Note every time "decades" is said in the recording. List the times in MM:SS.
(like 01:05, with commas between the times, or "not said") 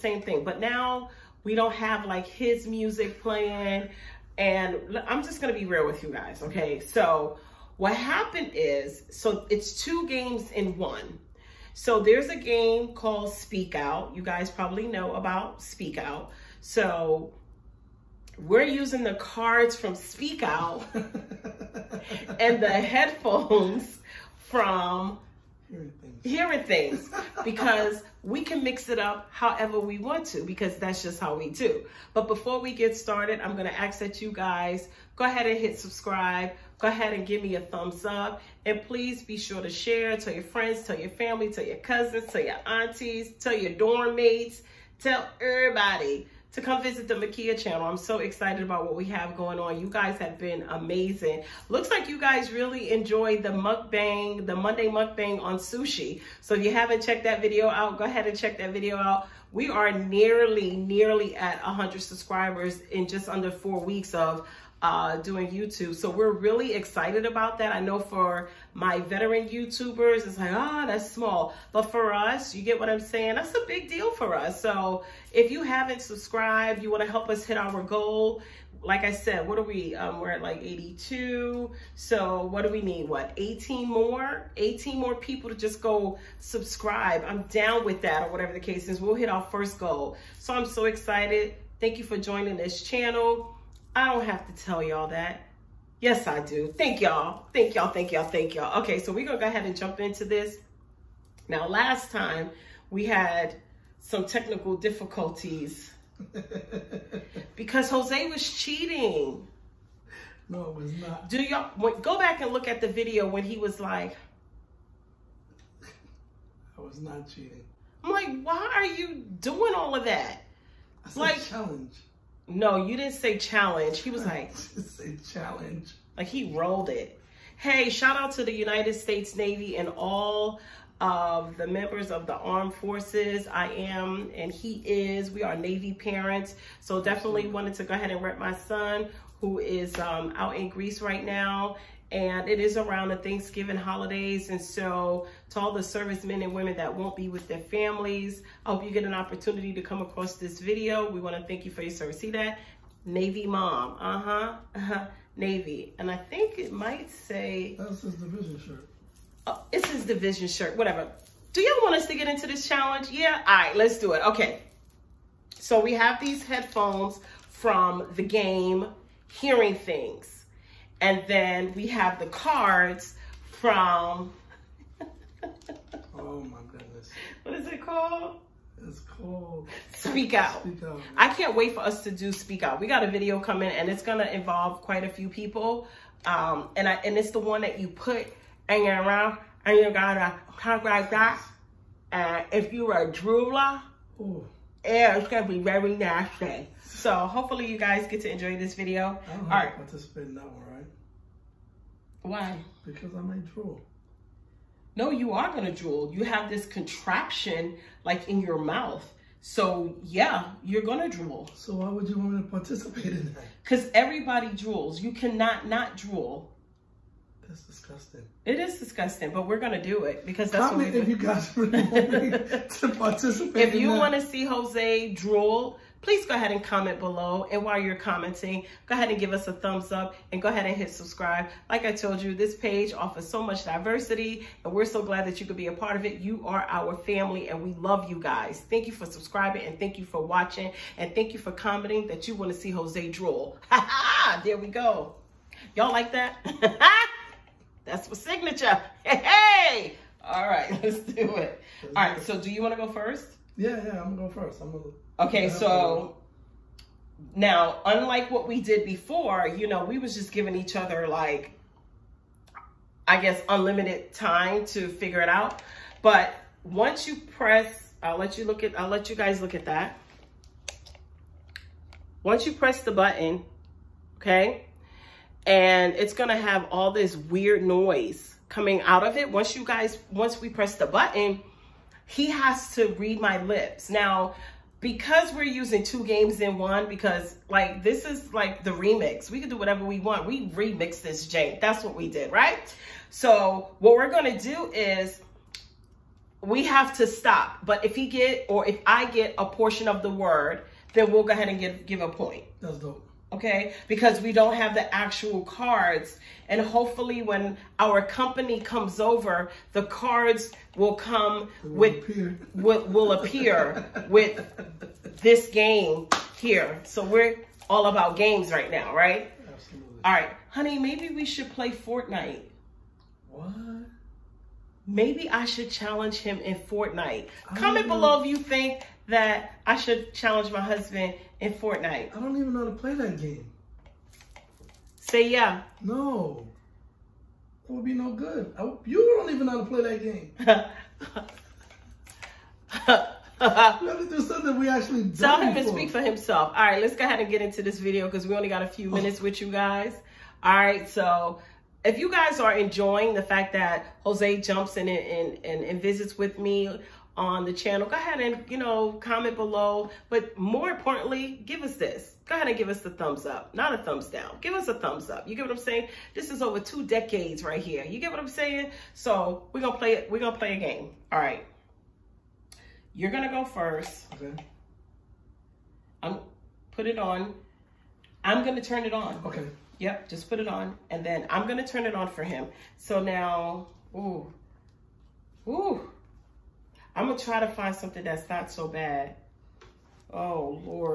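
06:06.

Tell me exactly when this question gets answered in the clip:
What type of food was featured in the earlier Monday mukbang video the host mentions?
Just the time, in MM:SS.
00:55.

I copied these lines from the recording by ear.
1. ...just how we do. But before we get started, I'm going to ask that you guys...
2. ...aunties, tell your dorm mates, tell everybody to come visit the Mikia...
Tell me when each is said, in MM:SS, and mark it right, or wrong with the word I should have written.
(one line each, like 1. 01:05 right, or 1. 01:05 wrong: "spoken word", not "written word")
1. 00:31 right
2. 00:42 right.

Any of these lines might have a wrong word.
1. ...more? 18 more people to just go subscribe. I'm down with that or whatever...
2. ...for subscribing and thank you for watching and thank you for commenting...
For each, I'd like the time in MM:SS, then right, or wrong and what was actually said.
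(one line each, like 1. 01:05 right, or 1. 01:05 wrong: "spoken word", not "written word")
1. 01:23 right
2. 03:58 right.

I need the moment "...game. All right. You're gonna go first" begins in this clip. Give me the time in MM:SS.
06:10.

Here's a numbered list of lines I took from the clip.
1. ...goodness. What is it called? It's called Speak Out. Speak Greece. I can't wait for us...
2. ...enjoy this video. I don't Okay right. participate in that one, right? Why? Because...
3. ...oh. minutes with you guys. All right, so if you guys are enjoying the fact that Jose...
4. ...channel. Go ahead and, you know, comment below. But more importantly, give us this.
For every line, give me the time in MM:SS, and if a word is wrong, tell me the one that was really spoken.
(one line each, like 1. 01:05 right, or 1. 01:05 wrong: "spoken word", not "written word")
1. 02:56 wrong: "Out", not "Greece"
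2. 03:18 wrong: "All", not "Okay"
3. 05:48 right
4. 05:57 right.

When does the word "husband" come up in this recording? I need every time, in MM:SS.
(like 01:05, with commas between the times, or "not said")
05:30.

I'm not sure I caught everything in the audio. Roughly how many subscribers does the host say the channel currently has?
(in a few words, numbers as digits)
82.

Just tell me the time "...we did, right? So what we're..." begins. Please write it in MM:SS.
04:51.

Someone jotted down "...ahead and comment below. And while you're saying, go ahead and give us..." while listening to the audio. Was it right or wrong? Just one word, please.
wrong.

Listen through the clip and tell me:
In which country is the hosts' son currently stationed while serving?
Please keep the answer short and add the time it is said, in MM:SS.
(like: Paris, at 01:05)
Greece, at 02:20.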